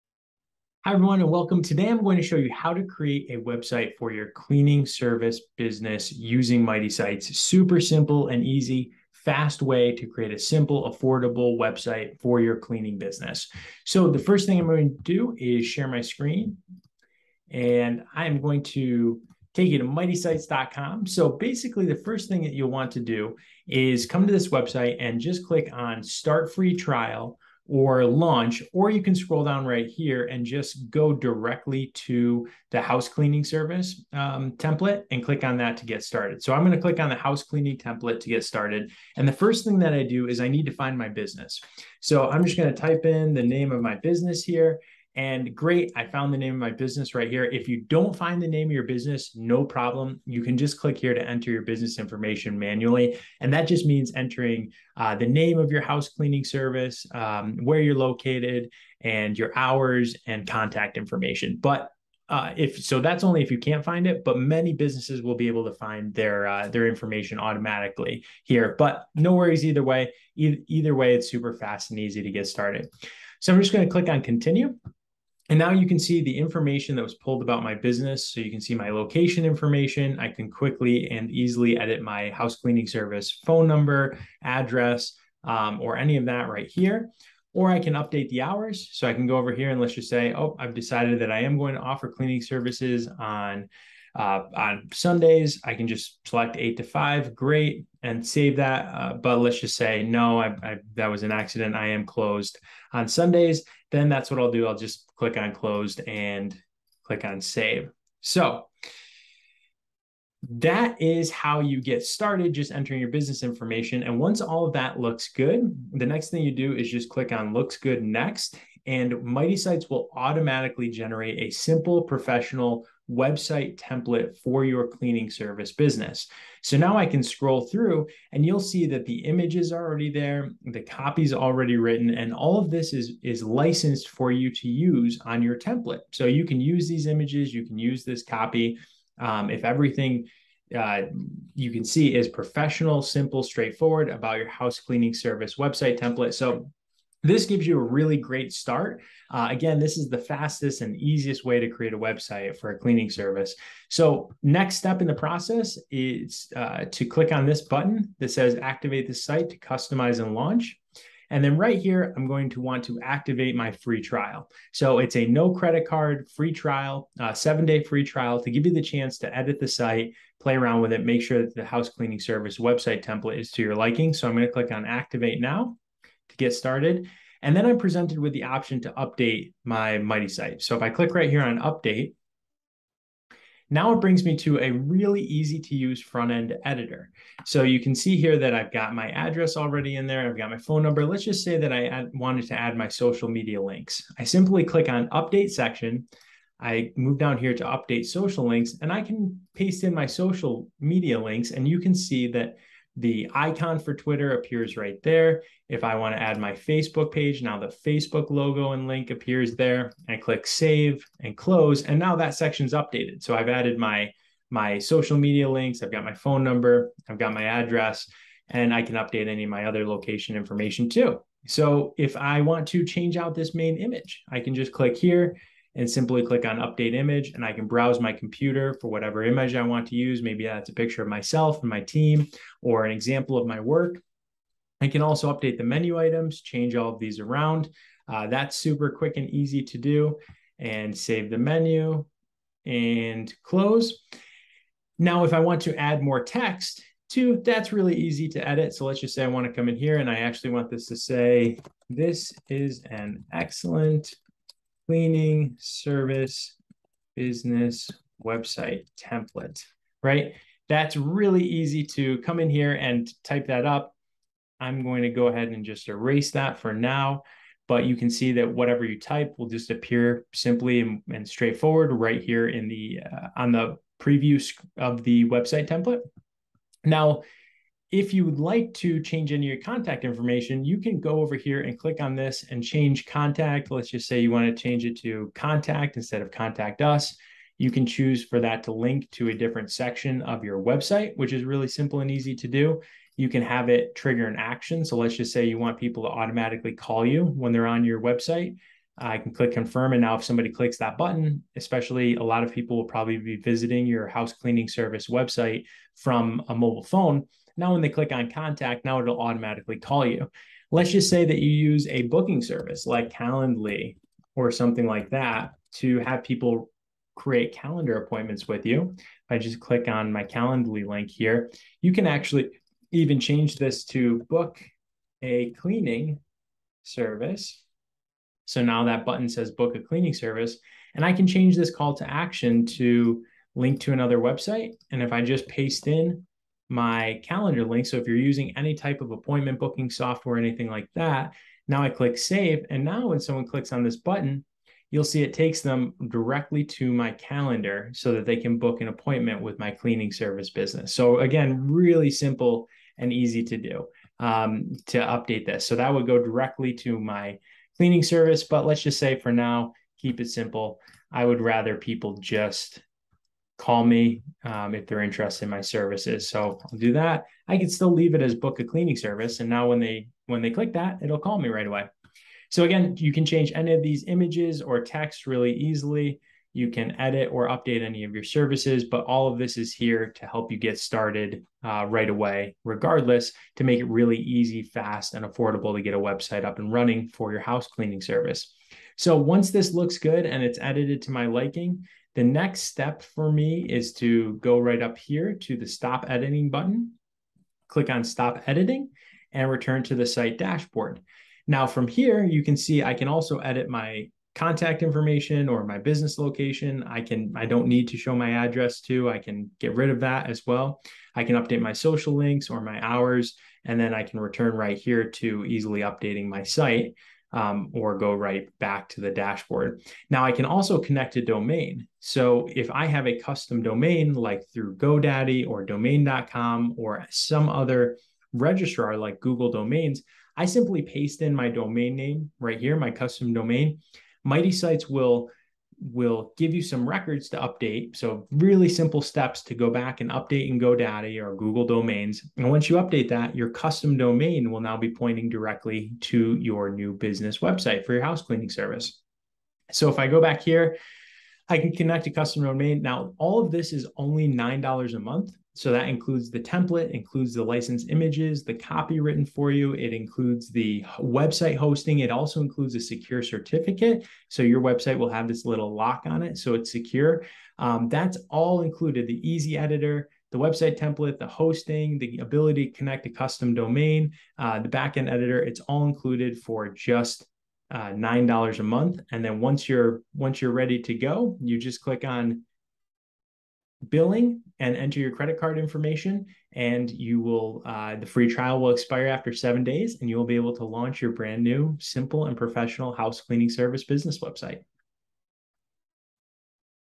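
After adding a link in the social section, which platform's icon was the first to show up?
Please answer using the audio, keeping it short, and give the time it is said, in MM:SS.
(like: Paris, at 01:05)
Twitter, at 03:23.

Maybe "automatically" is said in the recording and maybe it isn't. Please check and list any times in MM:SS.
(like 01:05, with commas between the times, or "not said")
01:07, 02:00, 04:56, 05:09.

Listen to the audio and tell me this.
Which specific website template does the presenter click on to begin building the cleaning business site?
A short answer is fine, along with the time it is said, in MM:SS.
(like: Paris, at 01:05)
House cleaning template, at 00:37.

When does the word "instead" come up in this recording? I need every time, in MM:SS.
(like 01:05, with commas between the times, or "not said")
04:45.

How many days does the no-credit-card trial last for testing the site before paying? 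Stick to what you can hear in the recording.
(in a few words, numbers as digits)
7 days.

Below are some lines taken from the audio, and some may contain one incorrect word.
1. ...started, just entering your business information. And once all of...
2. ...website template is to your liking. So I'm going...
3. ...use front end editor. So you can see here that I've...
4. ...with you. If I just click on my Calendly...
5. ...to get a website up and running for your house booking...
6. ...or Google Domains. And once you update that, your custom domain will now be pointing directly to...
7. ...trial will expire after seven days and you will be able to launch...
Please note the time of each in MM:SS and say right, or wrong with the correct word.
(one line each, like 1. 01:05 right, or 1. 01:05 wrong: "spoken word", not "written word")
1. 01:52 right
2. 02:52 right
3. 03:05 right
4. 05:18 right
5. 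06:25 wrong: "cleaning", not "booking"
6. 07:21 right
7. 08:08 right.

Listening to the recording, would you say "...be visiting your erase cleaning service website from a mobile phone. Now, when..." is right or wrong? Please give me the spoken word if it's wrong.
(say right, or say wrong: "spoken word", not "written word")
wrong: "house", not "erase".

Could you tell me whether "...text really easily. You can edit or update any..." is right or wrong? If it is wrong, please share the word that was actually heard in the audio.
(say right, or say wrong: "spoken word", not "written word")
right.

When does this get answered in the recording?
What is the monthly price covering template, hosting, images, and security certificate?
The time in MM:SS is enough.
07:34.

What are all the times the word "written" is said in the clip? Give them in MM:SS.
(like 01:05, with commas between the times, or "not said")
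02:11, 07:39.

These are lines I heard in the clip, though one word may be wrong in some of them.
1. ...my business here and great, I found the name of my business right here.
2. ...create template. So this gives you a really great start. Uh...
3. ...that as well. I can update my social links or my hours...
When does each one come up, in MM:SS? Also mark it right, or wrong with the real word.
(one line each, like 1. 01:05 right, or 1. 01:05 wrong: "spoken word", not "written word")
1. 00:43 right
2. 02:25 wrong: "website", not "create"
3. 06:50 right.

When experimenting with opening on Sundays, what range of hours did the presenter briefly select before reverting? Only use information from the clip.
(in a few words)
8 to 5.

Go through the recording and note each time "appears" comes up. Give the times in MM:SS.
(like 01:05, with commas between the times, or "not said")
03:24, 03:29, 04:29.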